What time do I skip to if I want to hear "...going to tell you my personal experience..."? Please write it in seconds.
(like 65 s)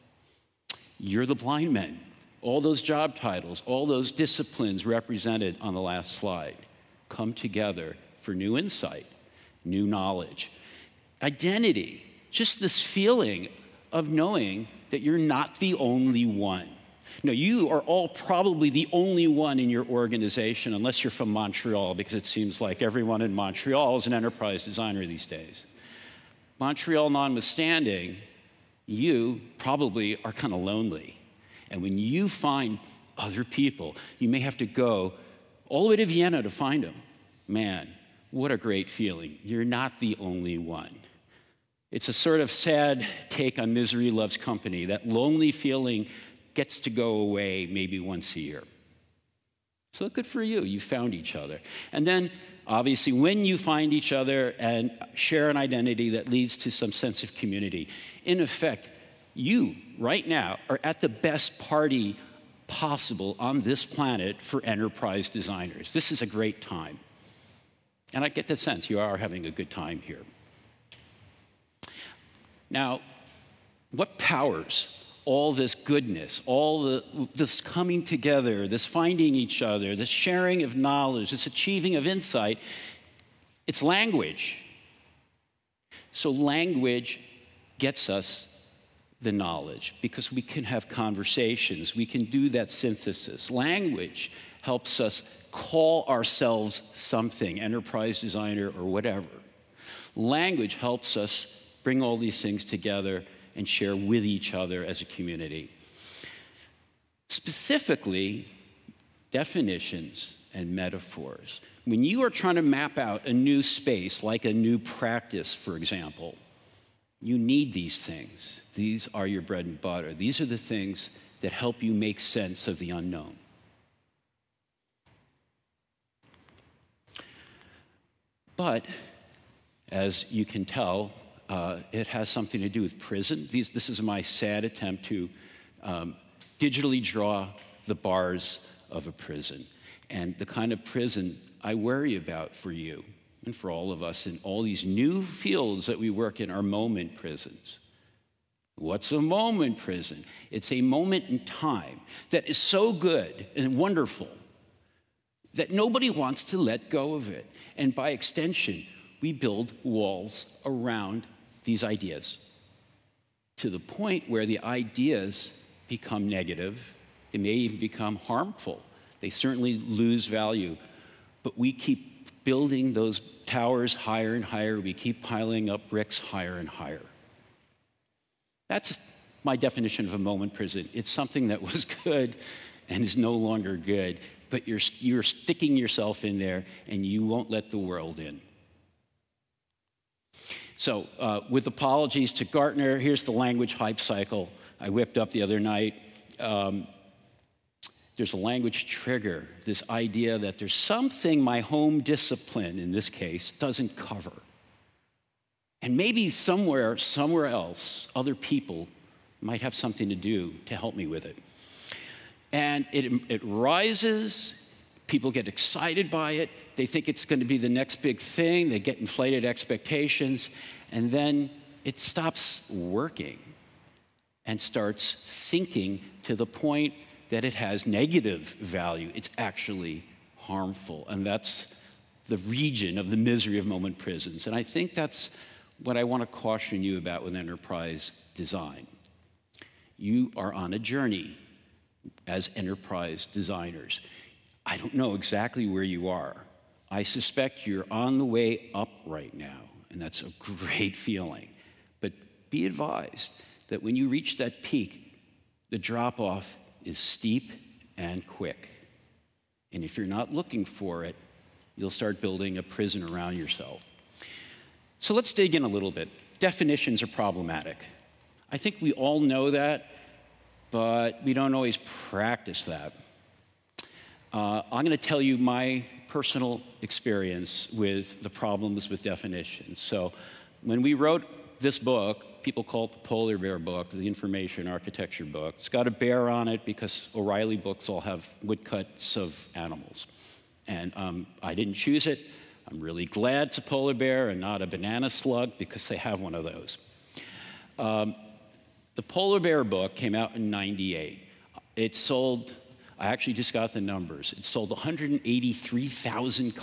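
274 s.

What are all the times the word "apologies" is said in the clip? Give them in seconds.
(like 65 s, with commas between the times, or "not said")
191 s.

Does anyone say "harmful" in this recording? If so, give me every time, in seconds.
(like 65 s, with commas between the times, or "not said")
168 s, 230 s.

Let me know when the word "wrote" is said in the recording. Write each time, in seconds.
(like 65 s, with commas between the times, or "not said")
280 s.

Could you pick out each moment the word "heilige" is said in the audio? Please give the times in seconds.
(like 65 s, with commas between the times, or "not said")
not said.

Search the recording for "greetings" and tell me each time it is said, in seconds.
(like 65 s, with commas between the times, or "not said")
not said.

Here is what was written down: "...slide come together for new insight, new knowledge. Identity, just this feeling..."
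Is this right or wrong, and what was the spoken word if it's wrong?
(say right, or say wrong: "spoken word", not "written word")
right.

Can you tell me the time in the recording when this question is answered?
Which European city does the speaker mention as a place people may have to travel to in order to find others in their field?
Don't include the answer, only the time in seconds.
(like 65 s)
36 s.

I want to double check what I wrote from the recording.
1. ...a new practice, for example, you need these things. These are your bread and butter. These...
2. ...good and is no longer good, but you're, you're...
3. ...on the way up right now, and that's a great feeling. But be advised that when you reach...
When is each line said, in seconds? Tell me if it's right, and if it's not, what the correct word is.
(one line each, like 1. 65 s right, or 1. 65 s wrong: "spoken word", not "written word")
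1. 114 s right
2. 182 s right
3. 247 s right.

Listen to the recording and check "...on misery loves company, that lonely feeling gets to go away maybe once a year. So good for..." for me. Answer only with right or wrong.
right.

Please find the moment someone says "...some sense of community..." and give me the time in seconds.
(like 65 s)
56 s.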